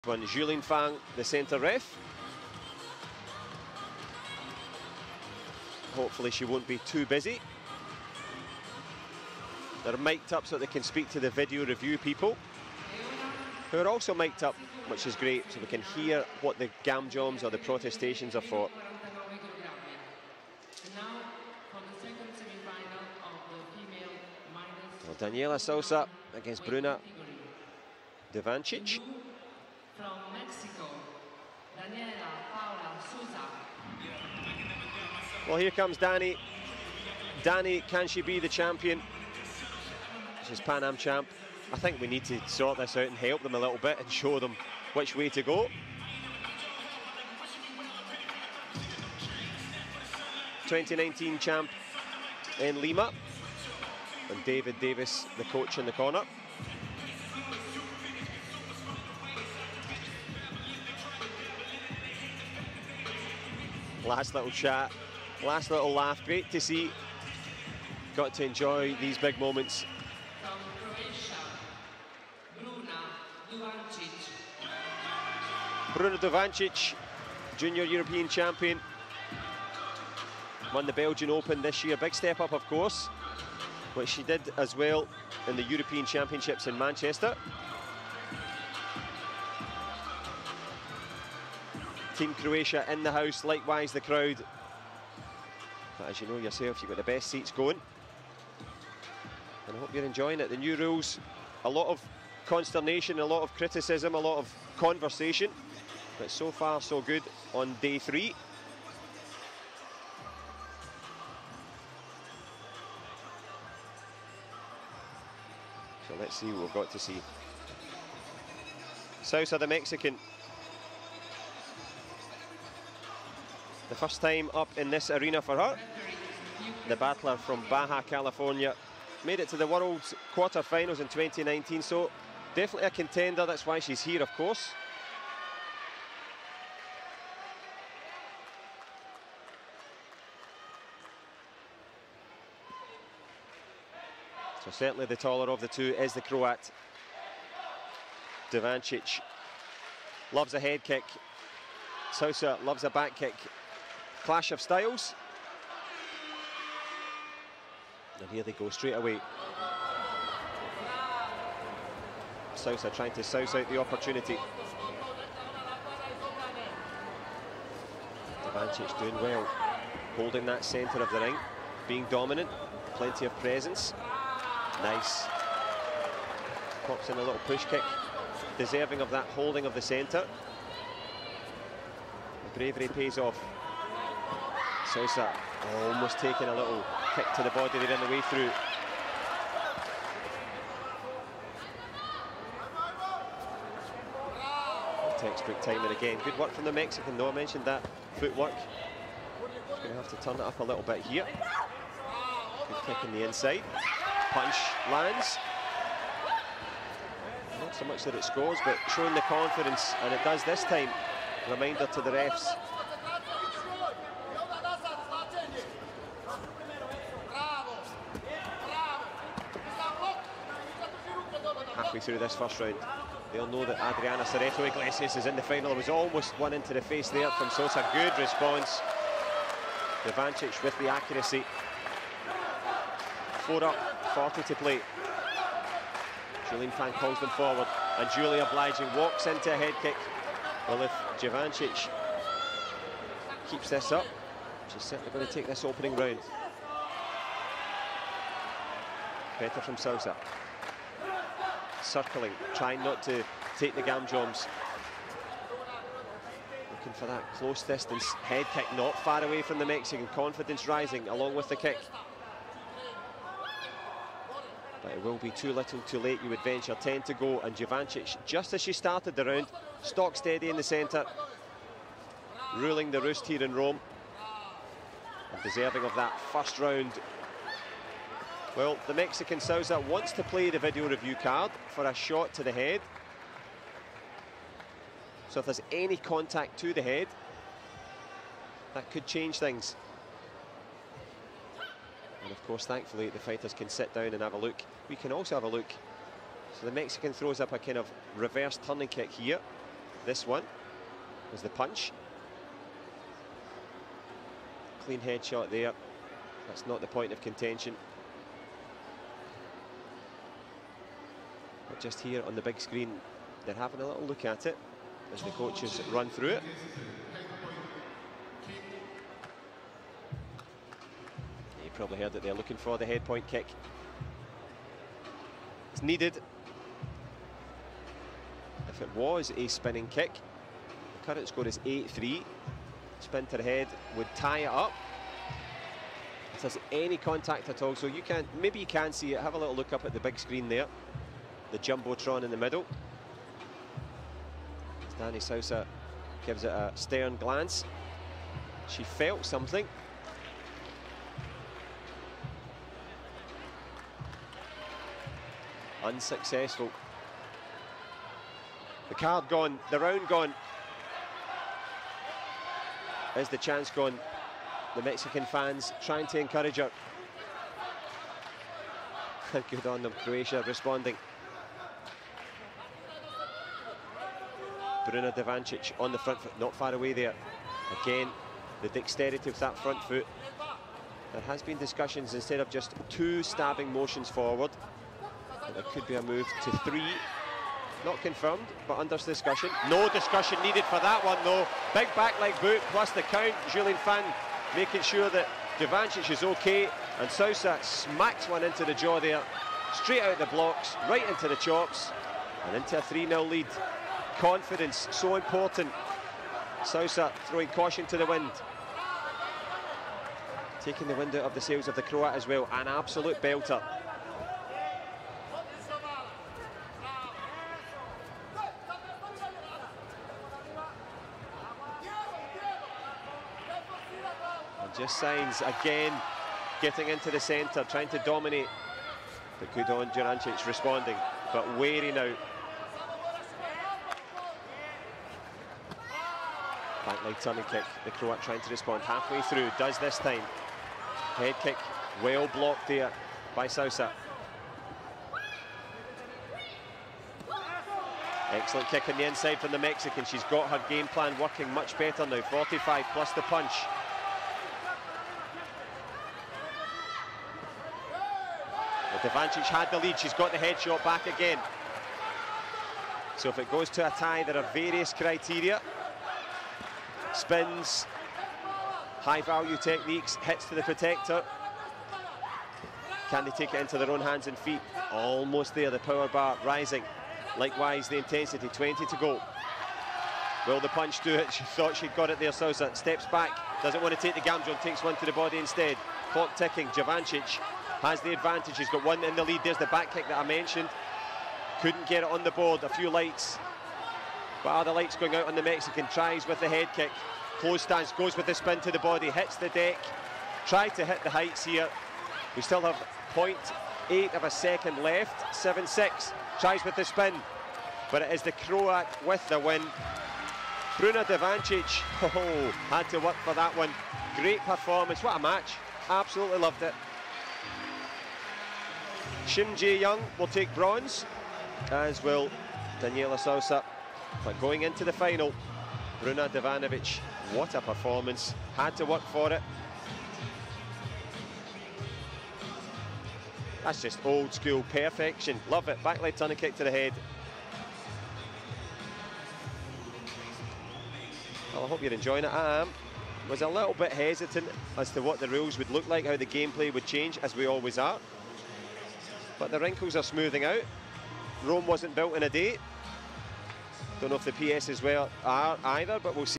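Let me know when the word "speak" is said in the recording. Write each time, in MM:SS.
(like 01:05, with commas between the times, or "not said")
00:10.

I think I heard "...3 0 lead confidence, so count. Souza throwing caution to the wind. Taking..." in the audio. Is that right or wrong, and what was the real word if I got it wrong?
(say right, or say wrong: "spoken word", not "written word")
wrong: "important", not "count".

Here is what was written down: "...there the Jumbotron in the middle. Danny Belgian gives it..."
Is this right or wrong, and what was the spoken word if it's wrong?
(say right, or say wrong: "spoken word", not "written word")
wrong: "Souza", not "Belgian".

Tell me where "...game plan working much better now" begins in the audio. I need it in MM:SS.
07:30.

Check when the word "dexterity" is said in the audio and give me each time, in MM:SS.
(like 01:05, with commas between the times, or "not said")
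06:18.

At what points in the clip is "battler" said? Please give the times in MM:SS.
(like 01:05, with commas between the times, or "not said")
02:06.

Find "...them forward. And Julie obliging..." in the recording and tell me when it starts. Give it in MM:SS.
03:57.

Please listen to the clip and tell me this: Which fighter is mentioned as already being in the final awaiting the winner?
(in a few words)
Adriana Cerezo Iglesias.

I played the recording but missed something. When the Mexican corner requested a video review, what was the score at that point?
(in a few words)
8-3.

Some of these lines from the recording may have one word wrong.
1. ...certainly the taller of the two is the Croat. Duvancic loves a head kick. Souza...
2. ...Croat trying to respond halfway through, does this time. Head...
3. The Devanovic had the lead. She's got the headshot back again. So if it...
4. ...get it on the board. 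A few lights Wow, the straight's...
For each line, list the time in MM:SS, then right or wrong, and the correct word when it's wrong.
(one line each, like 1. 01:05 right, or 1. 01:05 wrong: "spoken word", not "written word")
1. 02:24 right
2. 07:17 right
3. 07:38 wrong: "Duvancic", not "Devanovic"
4. 08:11 wrong: "light", not "straight".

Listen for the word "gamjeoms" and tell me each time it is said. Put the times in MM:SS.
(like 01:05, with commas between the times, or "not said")
00:16, 04:13, 08:04.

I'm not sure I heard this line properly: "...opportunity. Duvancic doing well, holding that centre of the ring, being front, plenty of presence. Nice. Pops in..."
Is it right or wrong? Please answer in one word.
wrong.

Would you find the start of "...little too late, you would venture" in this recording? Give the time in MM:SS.
04:25.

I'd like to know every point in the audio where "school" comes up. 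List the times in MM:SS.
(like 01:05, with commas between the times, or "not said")
08:54.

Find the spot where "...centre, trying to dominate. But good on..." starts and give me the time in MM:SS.
07:07.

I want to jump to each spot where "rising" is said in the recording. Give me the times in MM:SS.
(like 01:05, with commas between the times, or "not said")
04:20, 07:56.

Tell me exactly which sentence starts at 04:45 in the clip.
So if there's any contact to the head, that could change things.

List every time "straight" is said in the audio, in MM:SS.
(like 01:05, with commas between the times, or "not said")
02:38, 06:39.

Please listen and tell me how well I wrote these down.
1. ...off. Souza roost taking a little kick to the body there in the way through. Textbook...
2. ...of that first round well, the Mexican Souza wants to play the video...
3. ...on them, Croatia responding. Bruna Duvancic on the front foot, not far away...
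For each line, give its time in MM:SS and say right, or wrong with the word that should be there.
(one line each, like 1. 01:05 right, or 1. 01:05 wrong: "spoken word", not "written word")
1. 03:03 wrong: "almost", not "roost"
2. 04:35 right
3. 06:09 right.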